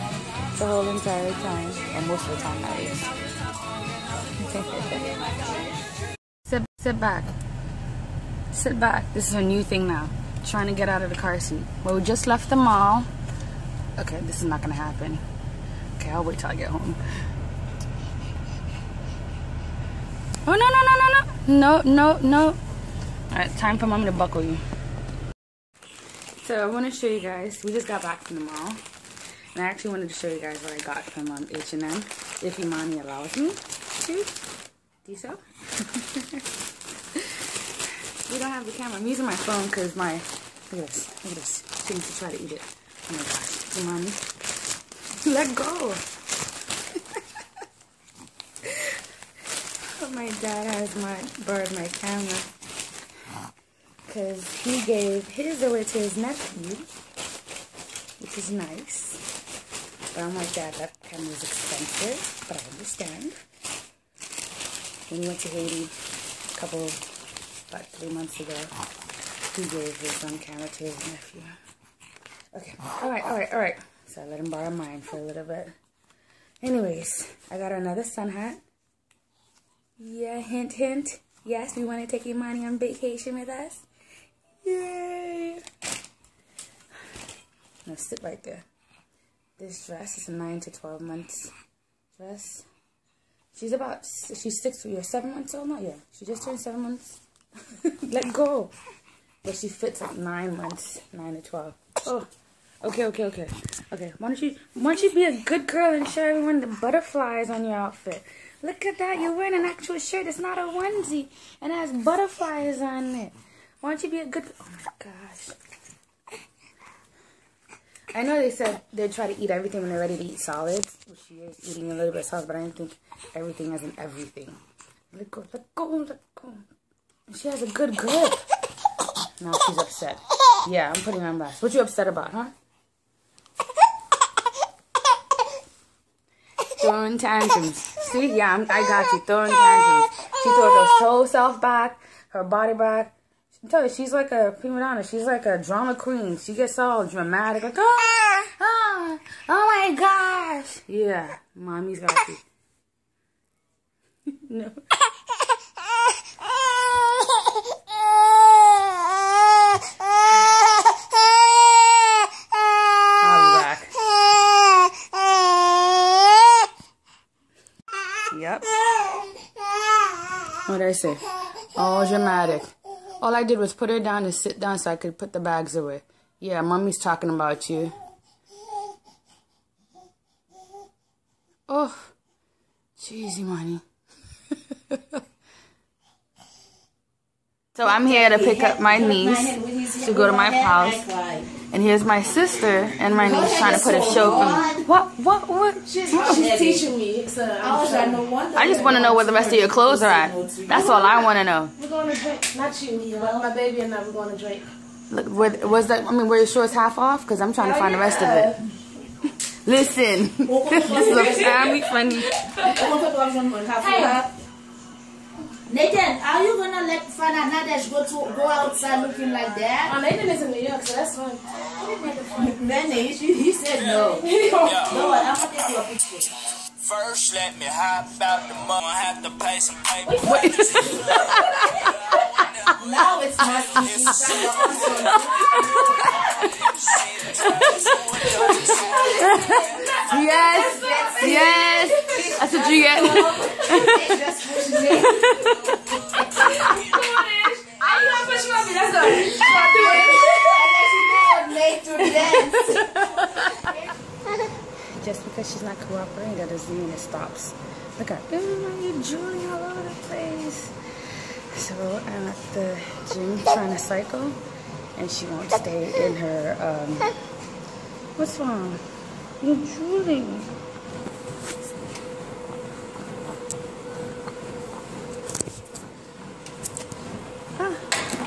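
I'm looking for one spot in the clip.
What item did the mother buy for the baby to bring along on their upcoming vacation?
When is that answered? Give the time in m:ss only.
1:18.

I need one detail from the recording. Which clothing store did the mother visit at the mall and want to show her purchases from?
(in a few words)
H&M.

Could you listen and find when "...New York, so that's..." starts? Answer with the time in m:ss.
3:40.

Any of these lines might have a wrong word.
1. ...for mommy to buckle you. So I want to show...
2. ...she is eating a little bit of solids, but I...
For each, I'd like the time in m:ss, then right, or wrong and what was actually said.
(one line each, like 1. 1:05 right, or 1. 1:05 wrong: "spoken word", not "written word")
1. 0:23 right
2. 2:01 right.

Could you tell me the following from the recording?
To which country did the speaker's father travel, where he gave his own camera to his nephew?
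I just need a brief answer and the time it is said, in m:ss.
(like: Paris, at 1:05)
Haiti, at 1:05.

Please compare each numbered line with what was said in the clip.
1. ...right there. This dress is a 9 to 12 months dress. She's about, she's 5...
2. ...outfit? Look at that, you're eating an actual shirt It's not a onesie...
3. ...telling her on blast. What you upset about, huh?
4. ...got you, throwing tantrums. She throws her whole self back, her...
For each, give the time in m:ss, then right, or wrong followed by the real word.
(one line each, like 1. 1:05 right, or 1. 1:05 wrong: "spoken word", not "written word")
1. 1:28 wrong: "6", not "5"
2. 1:47 wrong: "wearing", not "eating"
3. 2:11 wrong: "putting", not "telling"
4. 2:18 right.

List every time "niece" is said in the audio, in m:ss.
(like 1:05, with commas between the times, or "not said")
3:08, 3:13.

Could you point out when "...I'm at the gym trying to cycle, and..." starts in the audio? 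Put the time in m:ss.
4:22.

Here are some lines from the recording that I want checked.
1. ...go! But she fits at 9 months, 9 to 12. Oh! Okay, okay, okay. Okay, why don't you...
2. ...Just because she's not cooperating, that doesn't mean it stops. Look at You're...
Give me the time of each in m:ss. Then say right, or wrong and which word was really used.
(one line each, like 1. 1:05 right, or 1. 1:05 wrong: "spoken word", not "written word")
1. 1:38 right
2. 4:15 right.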